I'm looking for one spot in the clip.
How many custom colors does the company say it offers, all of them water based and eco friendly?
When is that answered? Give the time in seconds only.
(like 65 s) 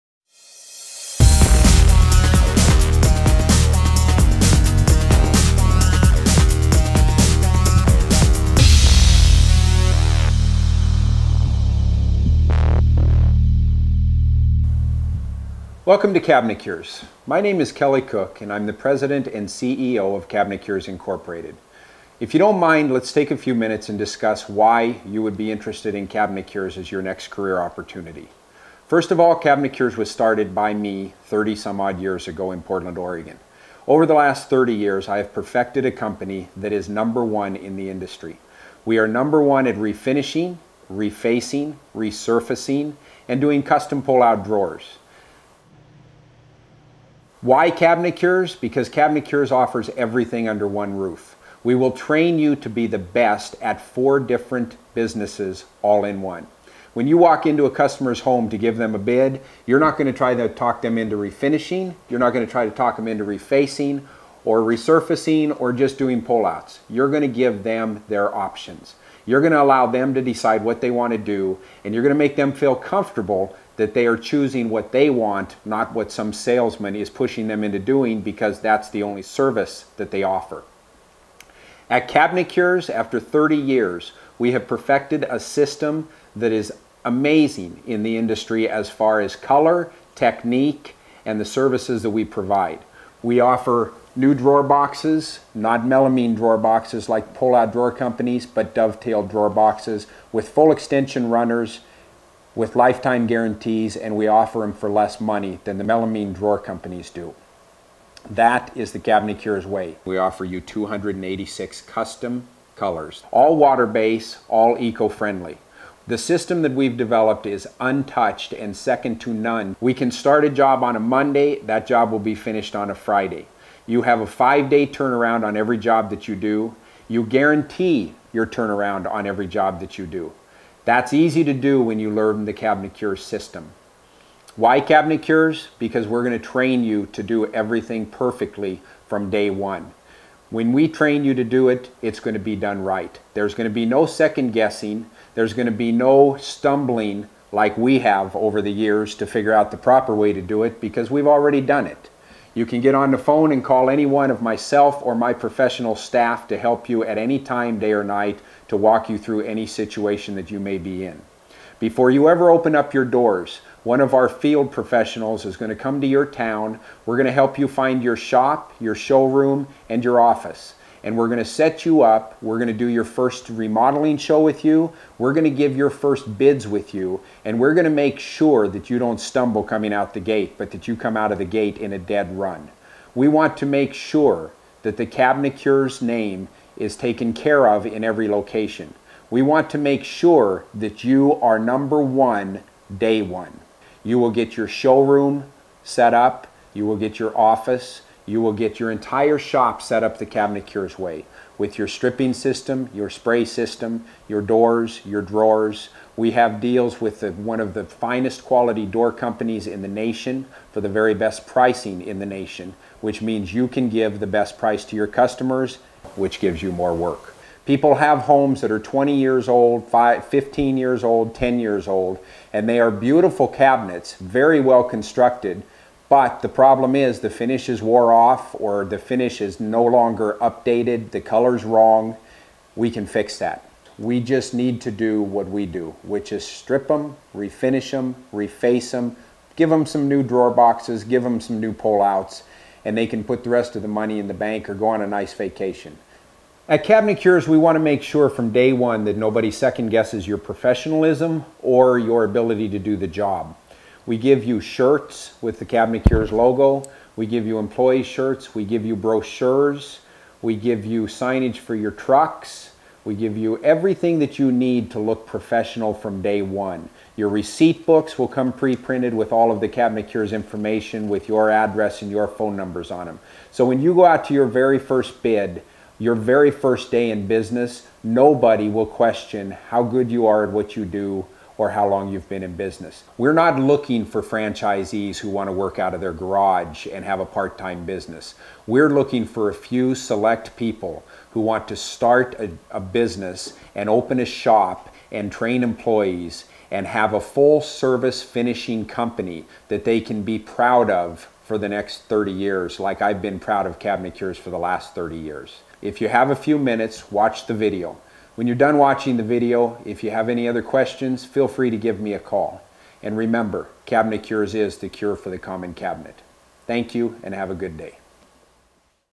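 110 s.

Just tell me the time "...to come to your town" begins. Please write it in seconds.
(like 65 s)
165 s.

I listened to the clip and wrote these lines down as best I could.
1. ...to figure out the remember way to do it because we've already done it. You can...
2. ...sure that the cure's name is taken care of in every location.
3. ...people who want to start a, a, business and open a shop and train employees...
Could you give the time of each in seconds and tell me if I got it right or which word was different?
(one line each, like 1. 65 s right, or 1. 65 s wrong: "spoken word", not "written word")
1. 149 s wrong: "proper", not "remember"
2. 183 s right
3. 290 s right.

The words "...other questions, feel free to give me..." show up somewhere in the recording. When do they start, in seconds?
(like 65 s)
310 s.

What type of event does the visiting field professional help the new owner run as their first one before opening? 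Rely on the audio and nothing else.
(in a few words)
Remodeling show.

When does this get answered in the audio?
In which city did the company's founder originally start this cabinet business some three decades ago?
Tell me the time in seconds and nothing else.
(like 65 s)
32 s.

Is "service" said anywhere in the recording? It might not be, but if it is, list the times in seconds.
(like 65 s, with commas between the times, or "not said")
79 s, 91 s, 297 s.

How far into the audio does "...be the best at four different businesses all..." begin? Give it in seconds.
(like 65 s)
52 s.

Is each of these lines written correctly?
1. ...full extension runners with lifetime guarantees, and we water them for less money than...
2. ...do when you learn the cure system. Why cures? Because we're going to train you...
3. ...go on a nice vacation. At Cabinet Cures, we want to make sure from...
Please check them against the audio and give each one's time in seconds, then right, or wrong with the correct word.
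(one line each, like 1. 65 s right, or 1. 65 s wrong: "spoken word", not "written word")
1. 100 s wrong: "offer", not "water"
2. 131 s right
3. 244 s right.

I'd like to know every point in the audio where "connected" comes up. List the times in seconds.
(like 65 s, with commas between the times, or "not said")
not said.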